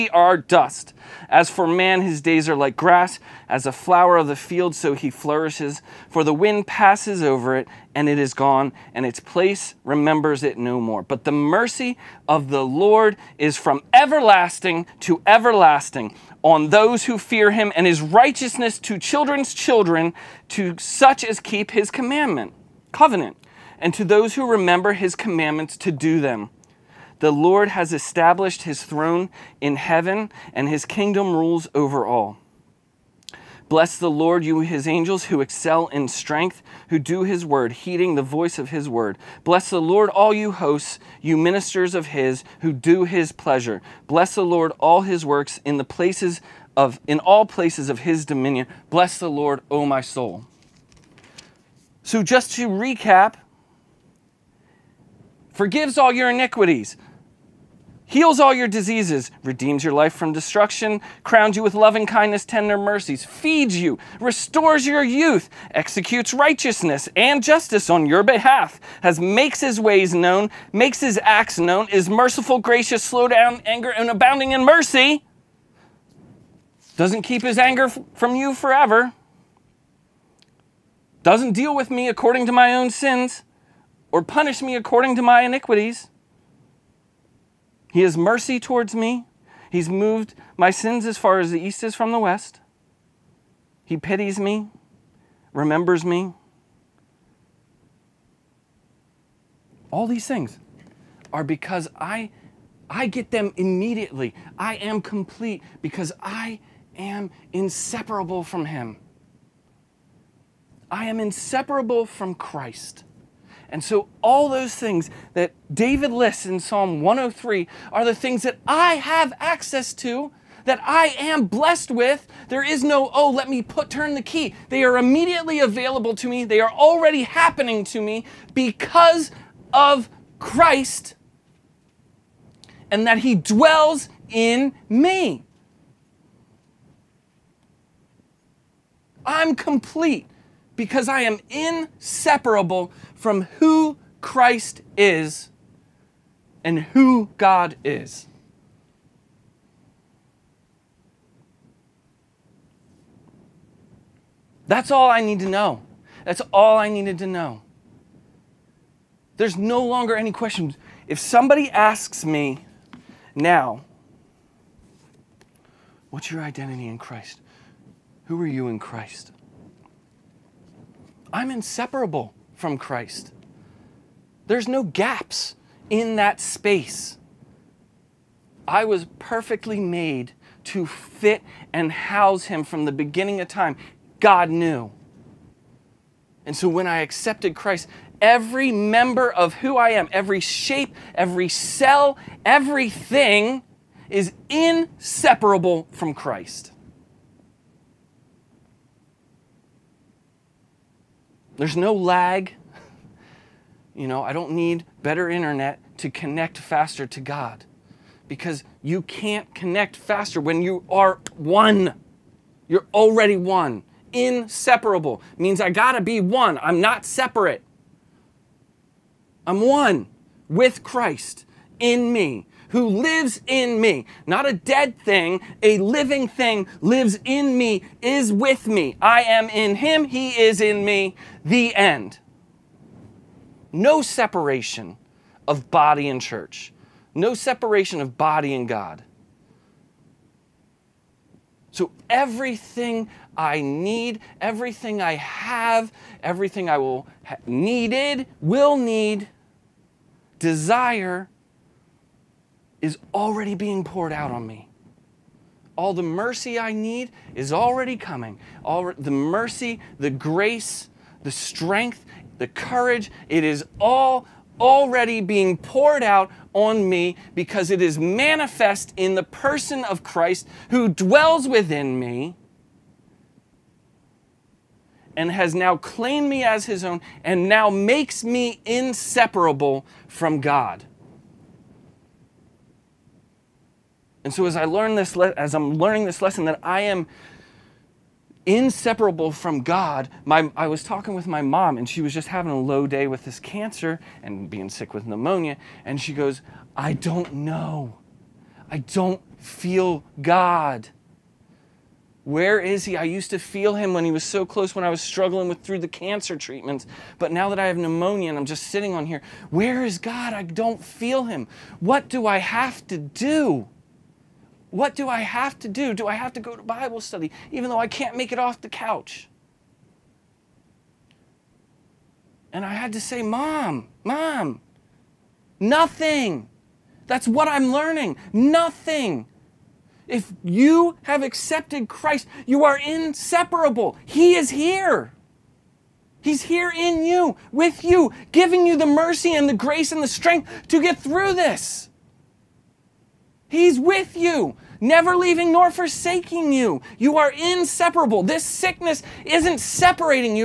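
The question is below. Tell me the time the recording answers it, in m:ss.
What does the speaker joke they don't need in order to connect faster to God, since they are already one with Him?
3:25.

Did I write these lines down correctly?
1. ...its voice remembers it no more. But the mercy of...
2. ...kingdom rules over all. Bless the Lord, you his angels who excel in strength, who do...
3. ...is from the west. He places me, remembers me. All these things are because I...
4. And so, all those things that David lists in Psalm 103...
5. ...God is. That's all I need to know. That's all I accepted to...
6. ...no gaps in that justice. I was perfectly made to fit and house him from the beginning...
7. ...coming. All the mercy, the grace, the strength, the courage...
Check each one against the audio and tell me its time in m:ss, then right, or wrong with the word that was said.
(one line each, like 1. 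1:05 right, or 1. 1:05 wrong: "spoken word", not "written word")
1. 0:09 wrong: "place", not "voice"
2. 0:30 right
3. 1:31 wrong: "pities", not "places"
4. 1:53 right
5. 2:27 wrong: "needed", not "accepted"
6. 2:54 wrong: "space", not "justice"
7. 4:17 right.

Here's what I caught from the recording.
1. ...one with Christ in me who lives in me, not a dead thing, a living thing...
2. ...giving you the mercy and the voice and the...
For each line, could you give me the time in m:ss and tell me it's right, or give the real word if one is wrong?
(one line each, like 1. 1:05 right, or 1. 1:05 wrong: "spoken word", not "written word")
1. 3:39 right
2. 5:38 wrong: "grace", not "voice".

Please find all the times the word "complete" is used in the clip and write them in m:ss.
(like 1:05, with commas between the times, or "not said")
1:45, 2:19.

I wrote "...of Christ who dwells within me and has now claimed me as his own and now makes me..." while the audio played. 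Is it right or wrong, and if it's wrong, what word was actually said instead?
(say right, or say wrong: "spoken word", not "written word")
right.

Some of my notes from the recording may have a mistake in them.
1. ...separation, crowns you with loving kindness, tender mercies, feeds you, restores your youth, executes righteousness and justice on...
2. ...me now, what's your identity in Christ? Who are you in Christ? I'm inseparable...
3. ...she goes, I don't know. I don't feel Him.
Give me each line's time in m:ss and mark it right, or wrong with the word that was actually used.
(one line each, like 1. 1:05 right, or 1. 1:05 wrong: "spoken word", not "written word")
1. 1:00 wrong: "destruction", not "separation"
2. 2:42 right
3. 4:55 wrong: "God", not "Him".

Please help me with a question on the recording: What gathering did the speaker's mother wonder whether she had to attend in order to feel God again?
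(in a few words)
Bible study.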